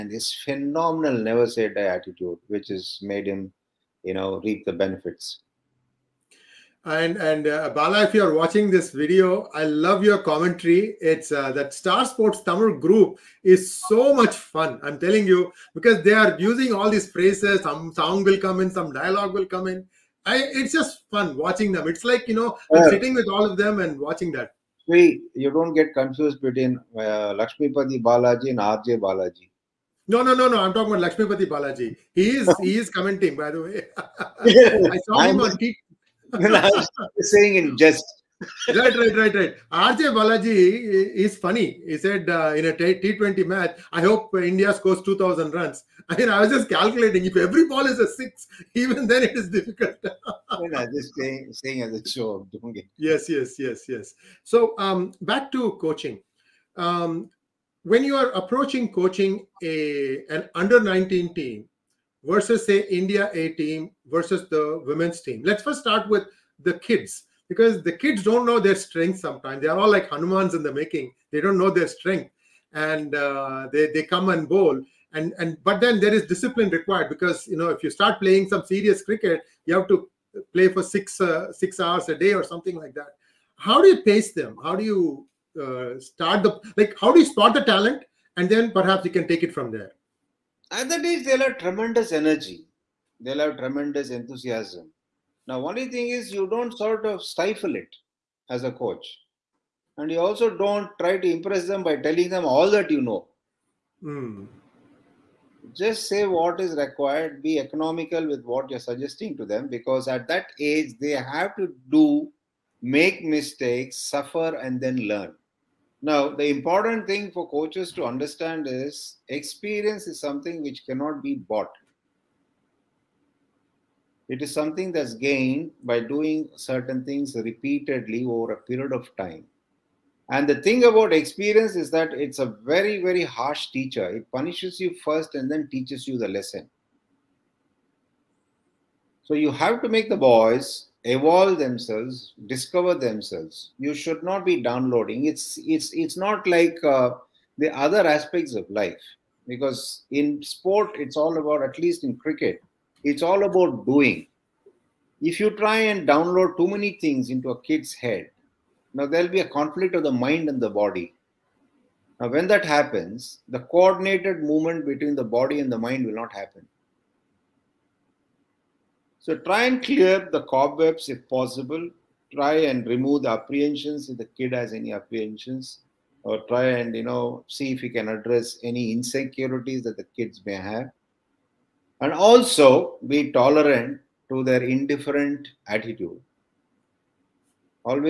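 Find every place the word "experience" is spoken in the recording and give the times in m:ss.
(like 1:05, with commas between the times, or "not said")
1:59, 2:11.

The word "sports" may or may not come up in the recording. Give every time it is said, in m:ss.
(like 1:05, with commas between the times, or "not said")
0:12, 2:30.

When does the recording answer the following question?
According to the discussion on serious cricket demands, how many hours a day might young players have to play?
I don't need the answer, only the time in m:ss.
1:21.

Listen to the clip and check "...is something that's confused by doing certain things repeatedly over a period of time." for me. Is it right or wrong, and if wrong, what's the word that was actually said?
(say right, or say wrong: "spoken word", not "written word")
wrong: "gained", not "confused".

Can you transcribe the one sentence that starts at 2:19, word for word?
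So you have to make the boys evolve themselves, discover themselves.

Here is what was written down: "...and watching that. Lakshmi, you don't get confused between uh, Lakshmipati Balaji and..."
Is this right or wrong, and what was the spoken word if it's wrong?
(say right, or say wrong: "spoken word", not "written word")
right.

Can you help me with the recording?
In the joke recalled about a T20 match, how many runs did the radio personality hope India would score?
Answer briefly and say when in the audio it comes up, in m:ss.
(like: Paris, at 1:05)
2,000, at 0:45.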